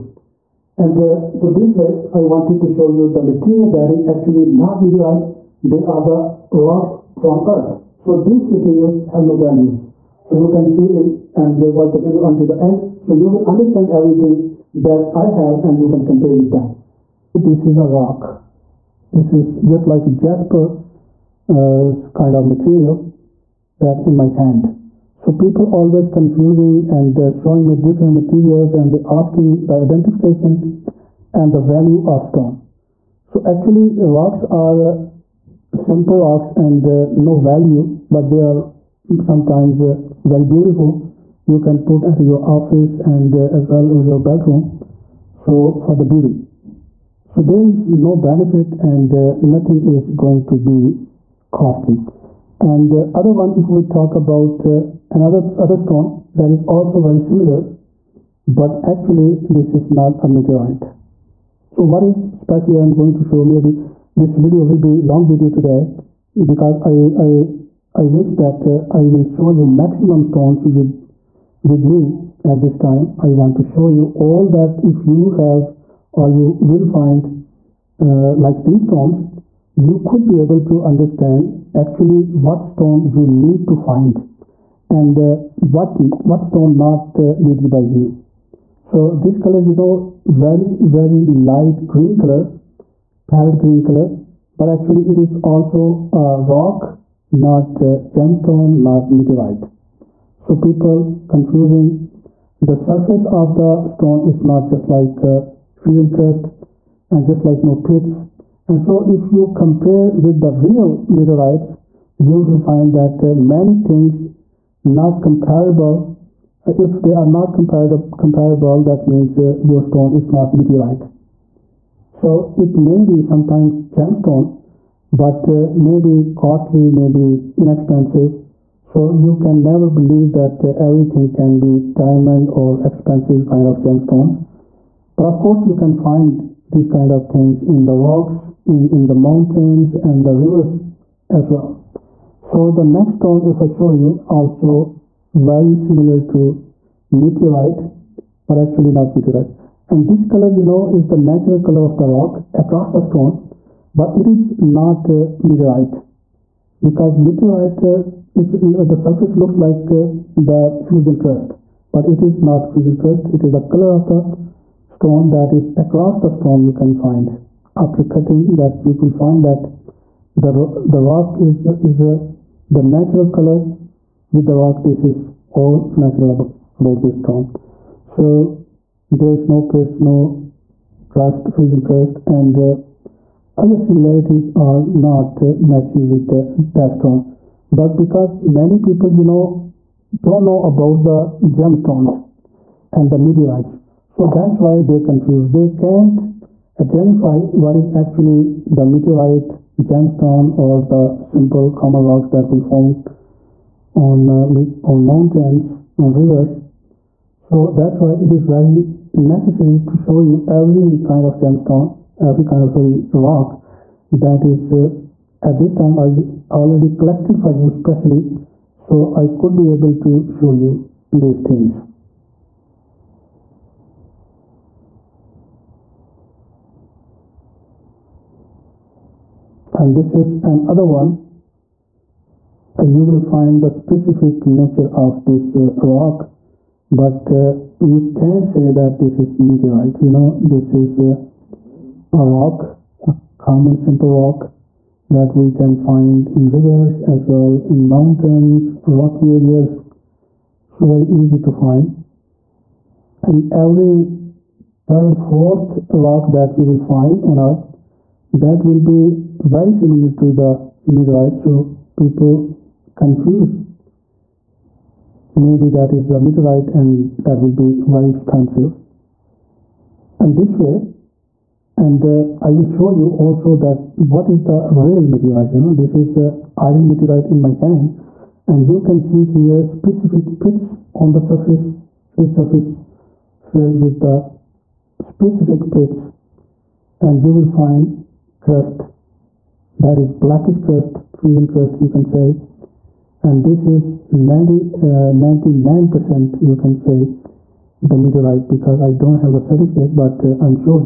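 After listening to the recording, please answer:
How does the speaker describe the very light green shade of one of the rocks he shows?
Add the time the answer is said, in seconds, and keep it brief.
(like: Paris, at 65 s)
Parrot green, at 93 s.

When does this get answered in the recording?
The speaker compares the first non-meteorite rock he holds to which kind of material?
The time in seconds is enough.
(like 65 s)
20 s.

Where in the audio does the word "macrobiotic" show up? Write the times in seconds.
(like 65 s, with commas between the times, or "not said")
not said.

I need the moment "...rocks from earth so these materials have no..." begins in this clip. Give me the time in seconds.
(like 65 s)
6 s.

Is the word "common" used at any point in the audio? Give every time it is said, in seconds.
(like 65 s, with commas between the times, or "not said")
201 s, 243 s.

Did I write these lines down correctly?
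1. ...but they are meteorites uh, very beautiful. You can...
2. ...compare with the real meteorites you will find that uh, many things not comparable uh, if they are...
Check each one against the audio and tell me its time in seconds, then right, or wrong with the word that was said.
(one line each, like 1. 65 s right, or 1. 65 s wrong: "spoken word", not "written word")
1. 38 s wrong: "sometimes", not "meteorites"
2. 109 s right.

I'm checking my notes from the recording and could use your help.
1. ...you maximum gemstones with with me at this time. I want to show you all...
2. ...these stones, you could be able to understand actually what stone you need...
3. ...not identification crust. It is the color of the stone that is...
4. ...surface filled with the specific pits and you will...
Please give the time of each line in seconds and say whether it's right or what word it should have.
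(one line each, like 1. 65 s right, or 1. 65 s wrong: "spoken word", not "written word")
1. 69 s wrong: "stones", not "gemstones"
2. 78 s right
3. 162 s wrong: "fusion", not "identification"
4. 282 s right.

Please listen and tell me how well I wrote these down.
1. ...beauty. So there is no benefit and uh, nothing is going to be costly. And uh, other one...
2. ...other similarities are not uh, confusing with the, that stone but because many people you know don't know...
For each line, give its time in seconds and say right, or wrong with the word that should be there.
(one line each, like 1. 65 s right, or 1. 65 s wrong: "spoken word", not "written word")
1. 46 s right
2. 183 s wrong: "matching", not "confusing".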